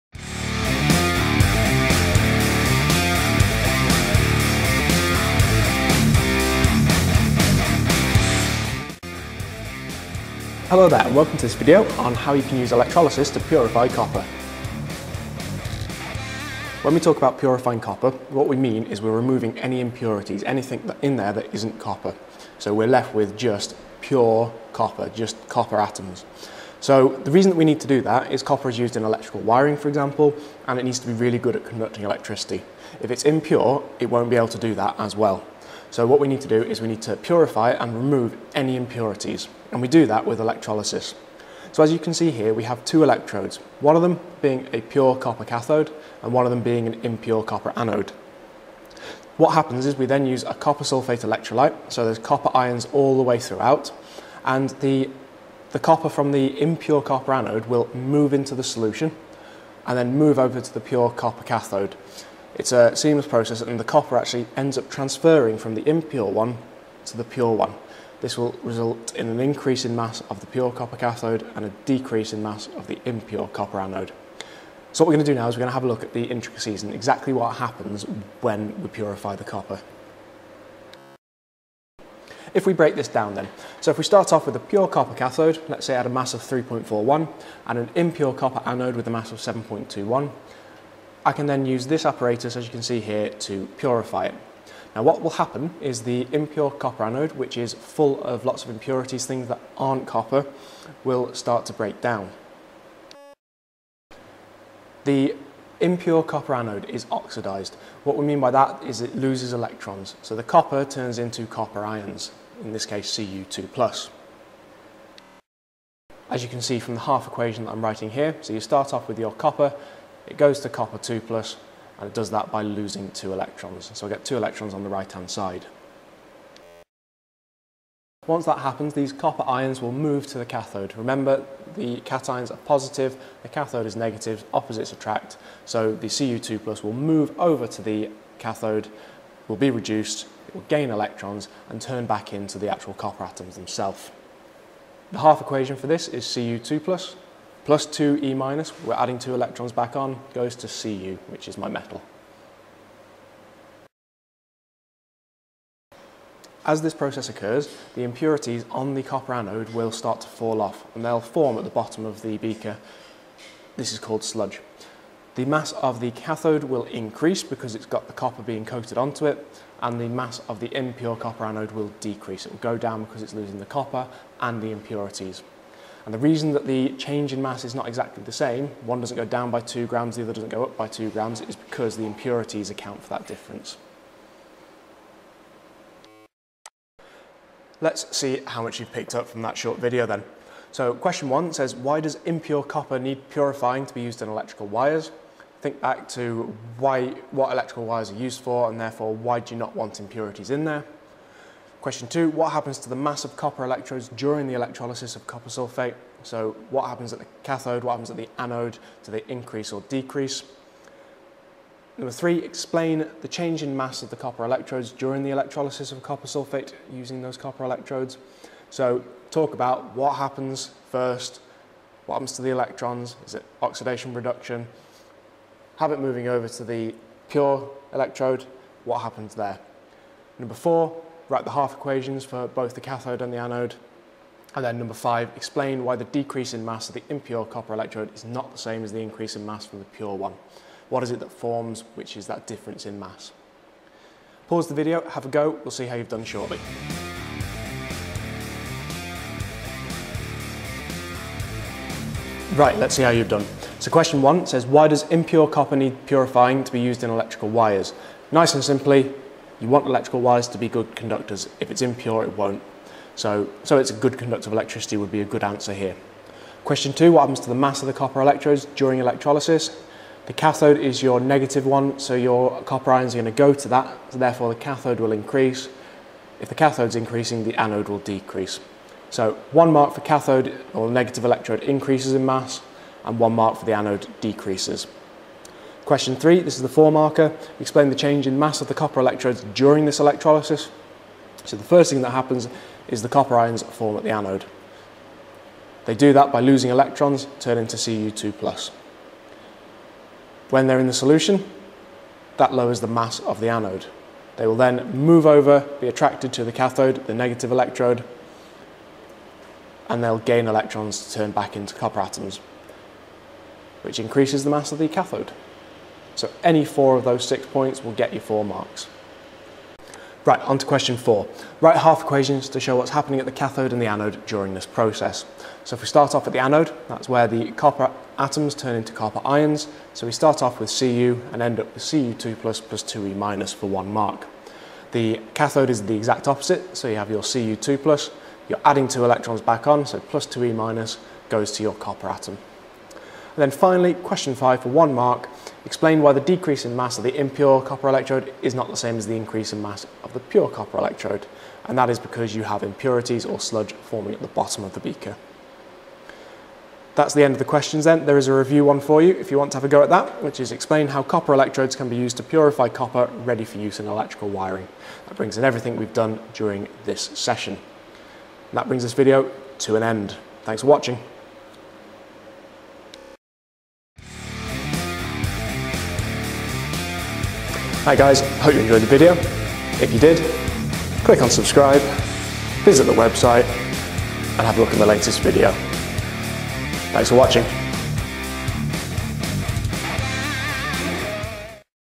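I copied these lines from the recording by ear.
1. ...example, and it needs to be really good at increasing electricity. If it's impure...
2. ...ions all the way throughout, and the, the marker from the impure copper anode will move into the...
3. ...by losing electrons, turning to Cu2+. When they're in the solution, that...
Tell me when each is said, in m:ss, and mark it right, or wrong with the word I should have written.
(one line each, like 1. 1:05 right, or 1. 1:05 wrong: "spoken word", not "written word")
1. 0:29 wrong: "conducting", not "increasing"
2. 0:52 wrong: "copper", not "marker"
3. 4:56 right.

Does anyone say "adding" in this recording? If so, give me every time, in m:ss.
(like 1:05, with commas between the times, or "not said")
2:28, 5:38.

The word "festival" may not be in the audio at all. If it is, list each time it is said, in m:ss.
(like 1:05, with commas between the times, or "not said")
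not said.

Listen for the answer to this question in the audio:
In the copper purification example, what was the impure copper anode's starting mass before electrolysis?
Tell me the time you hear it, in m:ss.
1:29.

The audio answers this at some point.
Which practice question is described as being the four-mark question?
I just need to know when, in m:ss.
4:45.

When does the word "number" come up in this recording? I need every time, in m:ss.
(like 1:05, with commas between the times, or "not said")
3:31, 3:50, 3:54.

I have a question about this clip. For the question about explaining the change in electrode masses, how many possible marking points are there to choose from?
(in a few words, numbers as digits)
6.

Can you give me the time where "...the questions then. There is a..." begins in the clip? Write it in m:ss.
5:57.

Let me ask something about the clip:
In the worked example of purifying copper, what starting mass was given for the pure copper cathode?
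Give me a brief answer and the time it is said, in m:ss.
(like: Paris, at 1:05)
3.41, at 1:26.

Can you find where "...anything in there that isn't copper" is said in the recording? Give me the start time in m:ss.
0:20.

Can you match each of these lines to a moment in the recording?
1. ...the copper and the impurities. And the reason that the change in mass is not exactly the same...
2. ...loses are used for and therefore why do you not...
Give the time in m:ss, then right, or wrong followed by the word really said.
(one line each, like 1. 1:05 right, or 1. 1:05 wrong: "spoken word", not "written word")
1. 2:53 right
2. 3:17 wrong: "wires", not "loses".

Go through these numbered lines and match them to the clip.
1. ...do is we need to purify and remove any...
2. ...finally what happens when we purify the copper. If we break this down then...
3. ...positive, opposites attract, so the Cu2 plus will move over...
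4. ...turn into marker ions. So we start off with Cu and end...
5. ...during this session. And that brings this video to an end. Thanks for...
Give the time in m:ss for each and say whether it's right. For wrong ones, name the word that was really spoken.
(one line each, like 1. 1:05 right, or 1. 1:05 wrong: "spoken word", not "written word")
1. 0:36 right
2. 1:16 wrong: "exactly", not "finally"
3. 2:13 wrong: "negative", not "positive"
4. 5:28 wrong: "copper", not "marker"
5. 6:06 right.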